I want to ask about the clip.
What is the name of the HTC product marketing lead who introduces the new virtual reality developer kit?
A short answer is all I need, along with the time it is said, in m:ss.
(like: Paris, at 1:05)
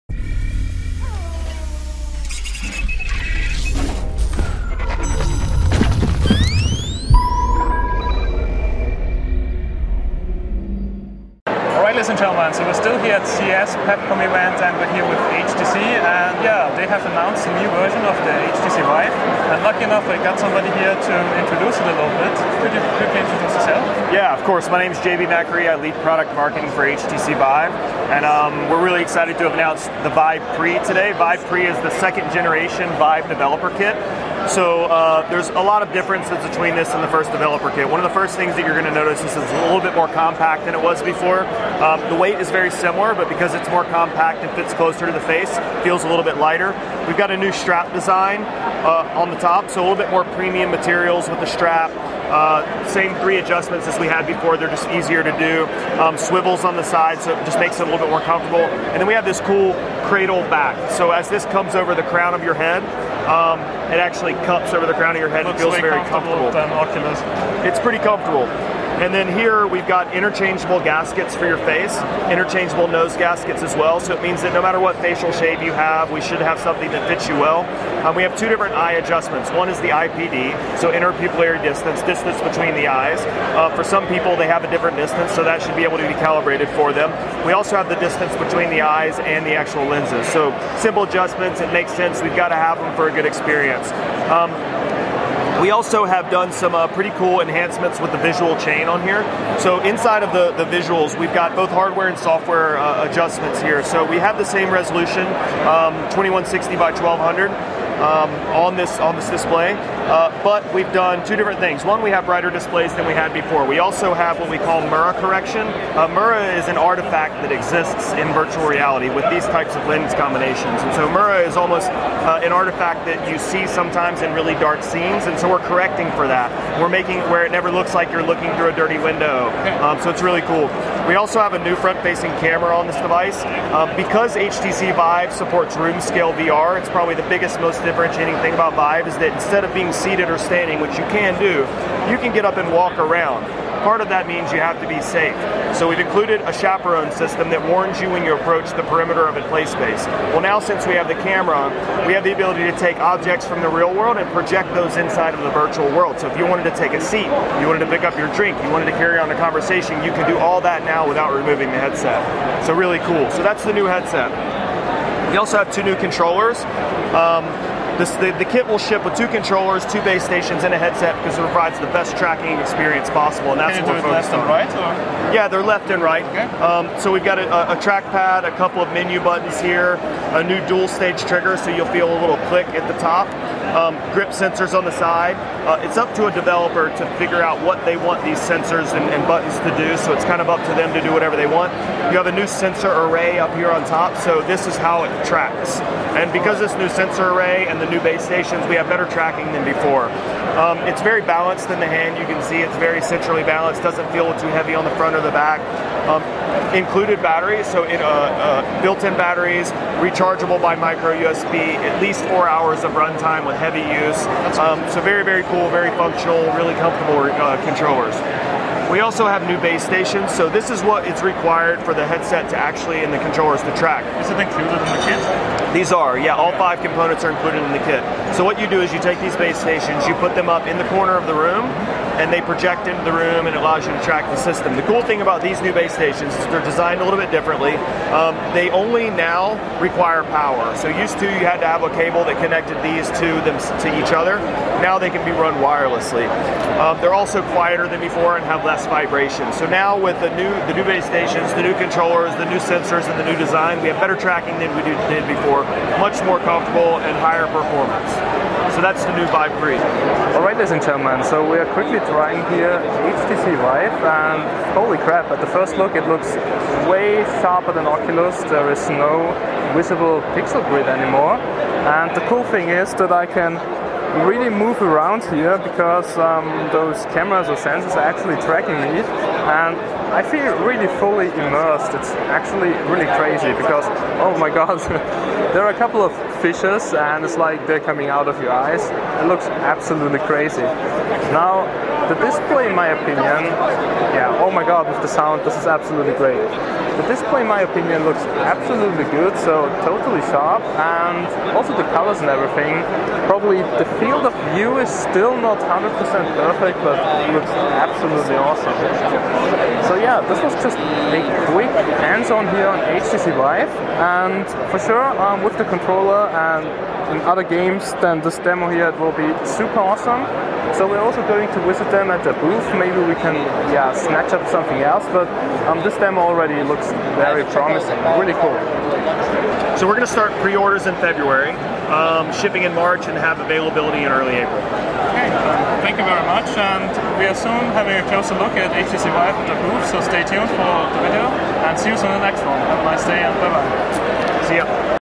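JB Macri, at 0:25.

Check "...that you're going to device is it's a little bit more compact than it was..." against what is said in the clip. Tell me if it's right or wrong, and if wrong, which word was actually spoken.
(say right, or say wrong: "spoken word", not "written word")
wrong: "notice", not "device".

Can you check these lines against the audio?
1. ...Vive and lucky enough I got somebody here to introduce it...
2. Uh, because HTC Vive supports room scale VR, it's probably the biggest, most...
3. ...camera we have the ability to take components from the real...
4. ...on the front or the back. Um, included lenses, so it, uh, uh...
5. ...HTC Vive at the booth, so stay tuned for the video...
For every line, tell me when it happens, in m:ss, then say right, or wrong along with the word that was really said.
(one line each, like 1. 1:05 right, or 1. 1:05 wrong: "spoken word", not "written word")
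1. 0:18 right
2. 2:13 right
3. 2:31 wrong: "objects", not "components"
4. 3:24 wrong: "batteries", not "lenses"
5. 5:38 right.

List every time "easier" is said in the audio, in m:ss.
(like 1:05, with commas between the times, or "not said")
0:54.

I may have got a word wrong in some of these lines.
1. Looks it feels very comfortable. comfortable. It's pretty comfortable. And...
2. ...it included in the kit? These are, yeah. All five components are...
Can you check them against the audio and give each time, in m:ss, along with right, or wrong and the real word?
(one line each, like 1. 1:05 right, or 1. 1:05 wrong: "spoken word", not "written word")
1. 1:05 right
2. 3:44 right.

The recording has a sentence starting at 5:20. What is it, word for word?
So we're also going to visit them at the booth.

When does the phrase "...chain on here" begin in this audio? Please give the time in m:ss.
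1:38.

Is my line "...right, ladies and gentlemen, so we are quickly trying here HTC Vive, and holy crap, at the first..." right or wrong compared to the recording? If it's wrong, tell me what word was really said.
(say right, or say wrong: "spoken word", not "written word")
right.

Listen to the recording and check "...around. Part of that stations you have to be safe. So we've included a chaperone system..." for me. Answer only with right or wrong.
wrong.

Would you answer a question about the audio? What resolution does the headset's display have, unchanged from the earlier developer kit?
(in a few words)
2160 by 1200.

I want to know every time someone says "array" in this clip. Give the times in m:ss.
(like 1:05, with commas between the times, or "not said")
3:12, 3:17.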